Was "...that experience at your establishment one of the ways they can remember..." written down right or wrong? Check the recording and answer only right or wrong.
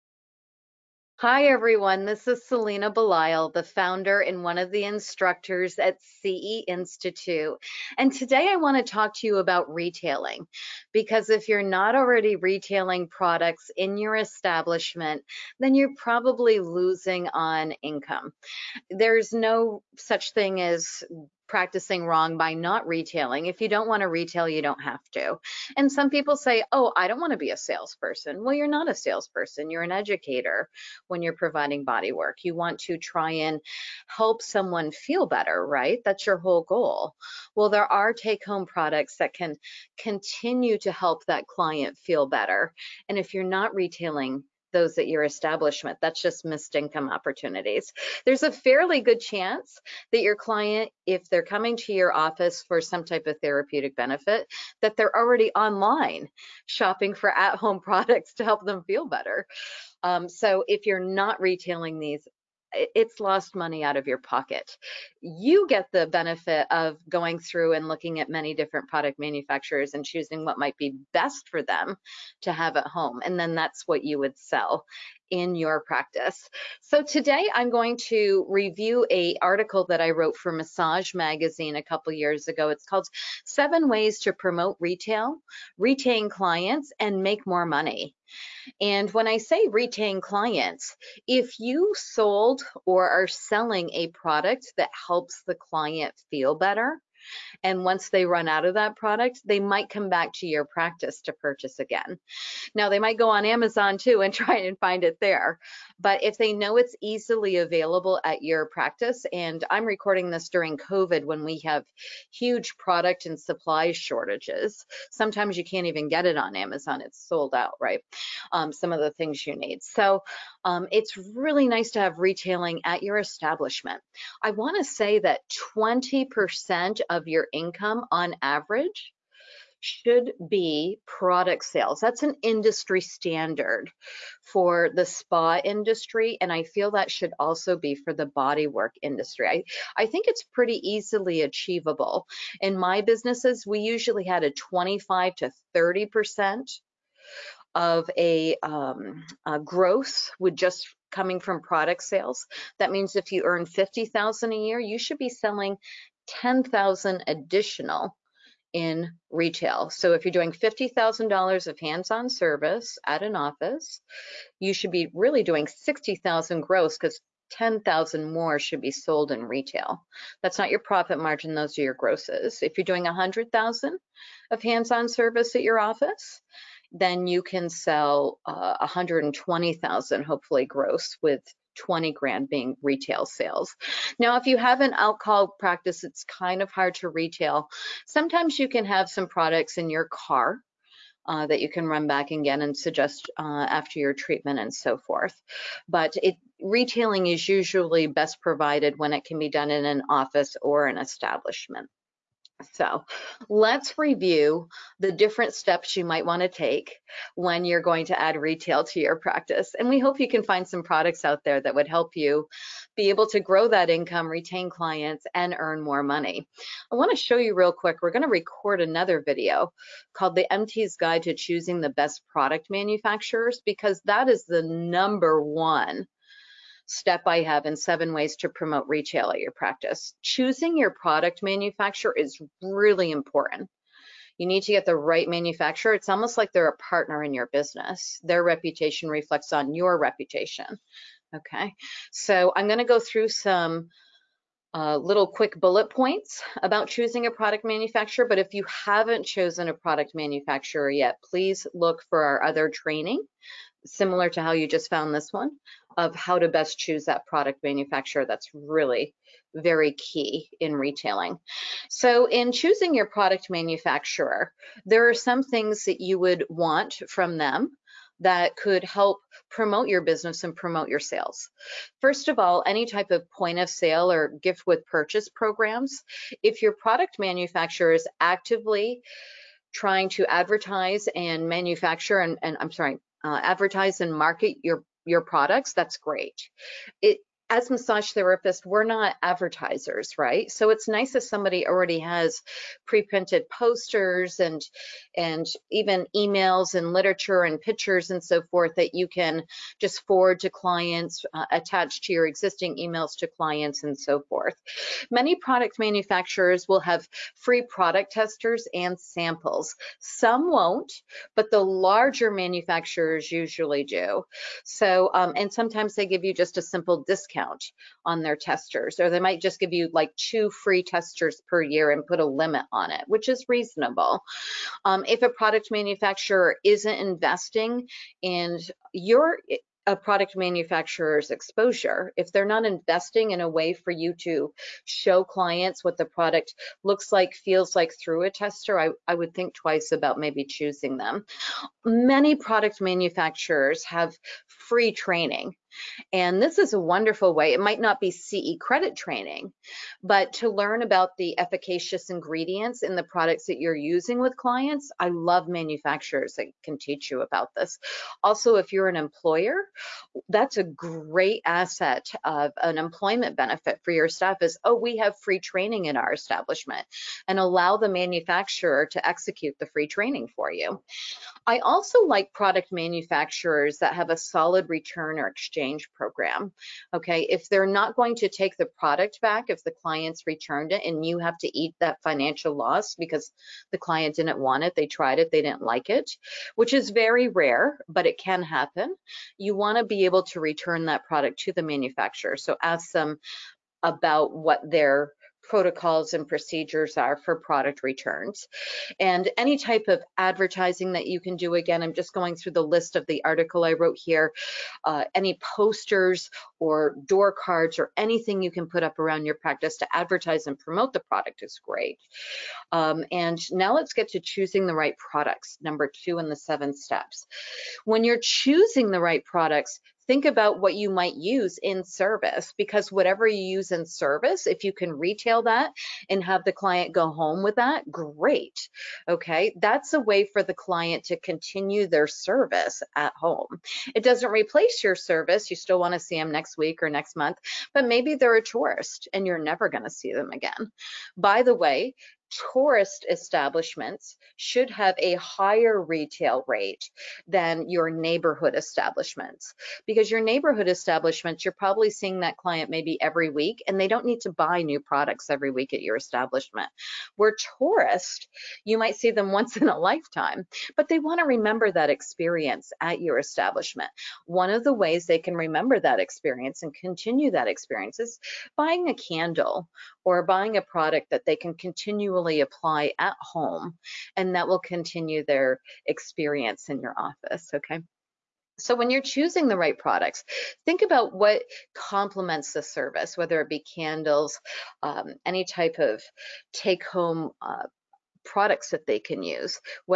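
right.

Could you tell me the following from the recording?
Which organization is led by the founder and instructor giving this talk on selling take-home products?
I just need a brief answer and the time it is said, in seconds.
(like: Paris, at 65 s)
CE Institute, at 6 s.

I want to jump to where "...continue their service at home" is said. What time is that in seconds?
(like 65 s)
431 s.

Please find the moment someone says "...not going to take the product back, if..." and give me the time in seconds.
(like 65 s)
377 s.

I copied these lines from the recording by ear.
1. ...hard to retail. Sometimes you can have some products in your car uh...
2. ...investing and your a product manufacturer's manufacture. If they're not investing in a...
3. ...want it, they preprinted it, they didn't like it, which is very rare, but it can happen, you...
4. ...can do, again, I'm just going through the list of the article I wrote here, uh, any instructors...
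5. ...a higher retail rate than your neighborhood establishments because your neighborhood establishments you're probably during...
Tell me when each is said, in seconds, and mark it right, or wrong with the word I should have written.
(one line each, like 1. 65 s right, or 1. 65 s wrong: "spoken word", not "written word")
1. 186 s right
2. 326 s wrong: "exposure", not "manufacture"
3. 384 s wrong: "tried", not "preprinted"
4. 401 s wrong: "posters", not "instructors"
5. 444 s wrong: "seeing", not "during".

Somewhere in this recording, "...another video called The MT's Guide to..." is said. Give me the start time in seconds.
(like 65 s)
218 s.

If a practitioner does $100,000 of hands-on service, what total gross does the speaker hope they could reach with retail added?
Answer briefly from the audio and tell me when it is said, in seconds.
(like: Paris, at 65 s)
120,000, at 178 s.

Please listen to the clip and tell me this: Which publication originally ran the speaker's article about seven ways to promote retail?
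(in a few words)
Massage Magazine.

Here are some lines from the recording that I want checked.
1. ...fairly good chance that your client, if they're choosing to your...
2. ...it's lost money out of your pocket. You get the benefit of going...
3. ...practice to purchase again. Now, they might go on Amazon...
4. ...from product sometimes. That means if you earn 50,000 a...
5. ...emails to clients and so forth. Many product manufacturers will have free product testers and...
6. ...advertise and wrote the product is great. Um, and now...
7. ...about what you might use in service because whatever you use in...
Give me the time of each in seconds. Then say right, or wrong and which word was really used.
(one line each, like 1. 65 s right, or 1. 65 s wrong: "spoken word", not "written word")
1. 48 s wrong: "coming", not "choosing"
2. 62 s right
3. 100 s right
4. 151 s wrong: "sales", not "sometimes"
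5. 302 s right
6. 409 s wrong: "promote", not "wrote"
7. 420 s right.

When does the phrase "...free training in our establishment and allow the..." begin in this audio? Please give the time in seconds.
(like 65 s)
365 s.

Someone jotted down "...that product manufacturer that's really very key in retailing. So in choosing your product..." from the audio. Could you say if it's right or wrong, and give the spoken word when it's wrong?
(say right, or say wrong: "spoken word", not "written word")
right.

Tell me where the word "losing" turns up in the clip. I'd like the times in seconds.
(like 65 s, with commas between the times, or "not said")
16 s.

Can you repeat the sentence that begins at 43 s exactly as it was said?
And if you're not retailing, those at your establishment.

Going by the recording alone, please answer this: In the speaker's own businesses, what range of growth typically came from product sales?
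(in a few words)
25 to 30%.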